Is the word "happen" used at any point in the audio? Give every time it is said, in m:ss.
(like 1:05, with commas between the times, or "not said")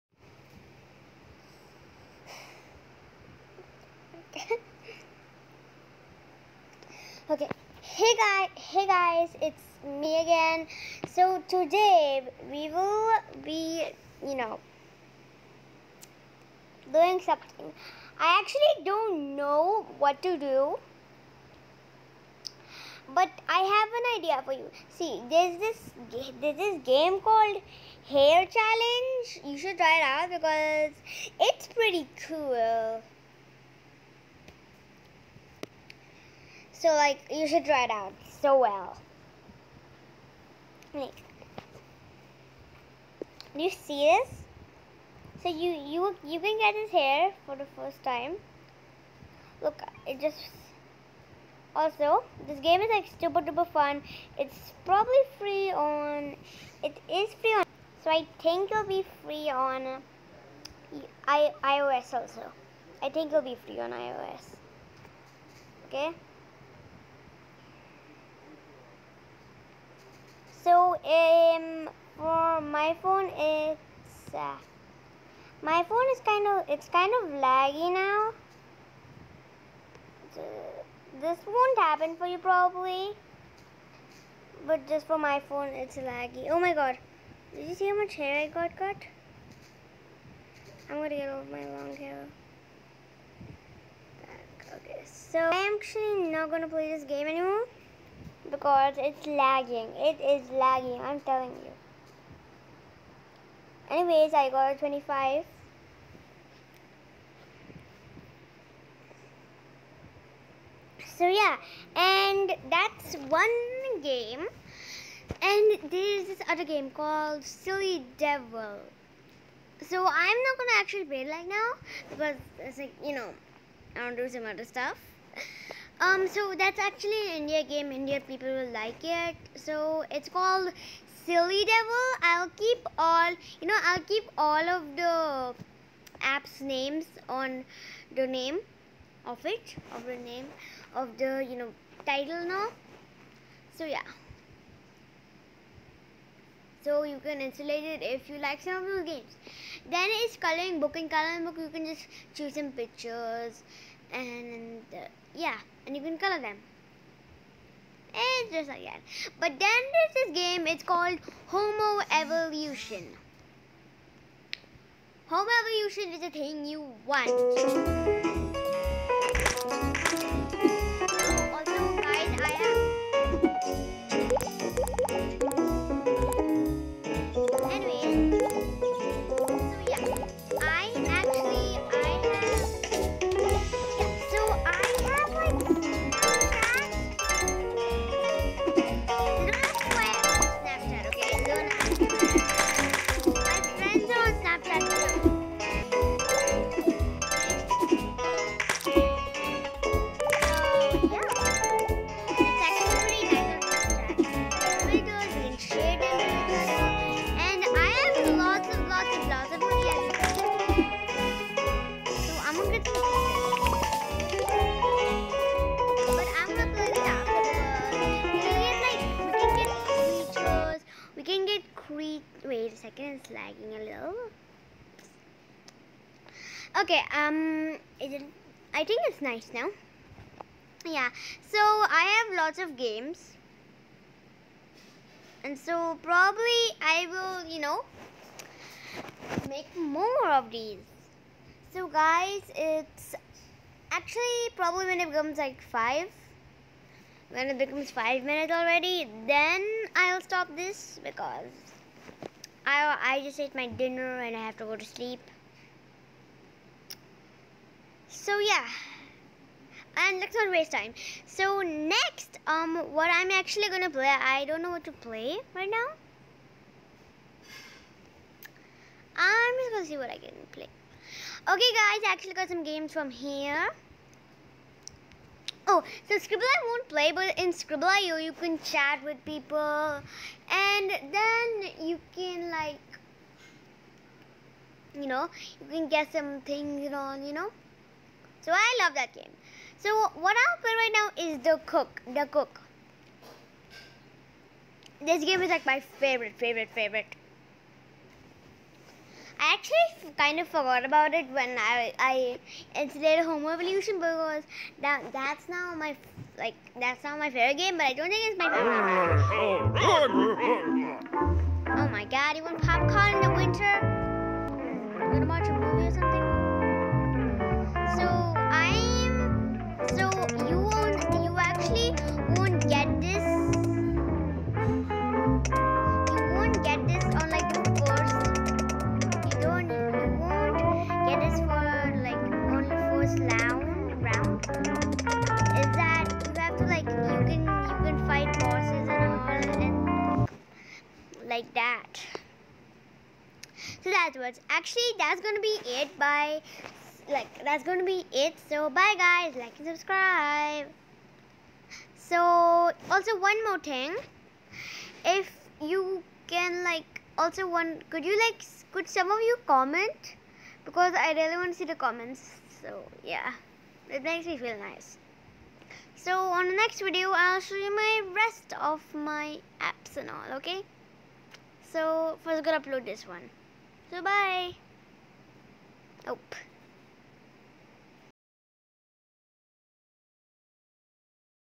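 1:21.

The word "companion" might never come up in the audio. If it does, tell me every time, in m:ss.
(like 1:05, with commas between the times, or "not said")
not said.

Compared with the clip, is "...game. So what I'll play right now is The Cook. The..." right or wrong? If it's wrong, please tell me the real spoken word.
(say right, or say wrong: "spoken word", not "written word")
right.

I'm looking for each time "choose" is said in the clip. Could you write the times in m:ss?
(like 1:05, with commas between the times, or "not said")
2:32.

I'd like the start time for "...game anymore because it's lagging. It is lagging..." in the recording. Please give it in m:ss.
1:37.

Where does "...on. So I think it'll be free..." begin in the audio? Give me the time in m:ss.
0:57.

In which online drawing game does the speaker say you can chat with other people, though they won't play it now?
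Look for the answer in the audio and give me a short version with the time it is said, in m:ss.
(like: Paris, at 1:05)
skribbl.io, at 4:37.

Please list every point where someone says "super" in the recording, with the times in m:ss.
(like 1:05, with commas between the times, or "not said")
0:53.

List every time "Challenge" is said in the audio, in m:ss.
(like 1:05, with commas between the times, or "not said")
0:28.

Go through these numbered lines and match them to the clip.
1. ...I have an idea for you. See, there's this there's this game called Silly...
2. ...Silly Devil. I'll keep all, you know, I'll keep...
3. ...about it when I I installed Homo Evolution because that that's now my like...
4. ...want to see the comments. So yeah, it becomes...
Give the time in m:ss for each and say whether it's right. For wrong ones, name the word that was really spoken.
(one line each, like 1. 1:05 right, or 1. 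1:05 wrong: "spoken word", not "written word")
1. 0:23 wrong: "Hair", not "Silly"
2. 2:11 right
3. 5:00 right
4. 6:01 wrong: "makes", not "becomes".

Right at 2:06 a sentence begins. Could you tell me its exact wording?
Um, so that's actually an India game.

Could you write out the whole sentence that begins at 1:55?
And there's this other game called Silly Devil.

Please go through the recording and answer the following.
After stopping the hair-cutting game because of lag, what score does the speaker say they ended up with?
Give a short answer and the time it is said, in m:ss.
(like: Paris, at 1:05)
25, at 1:44.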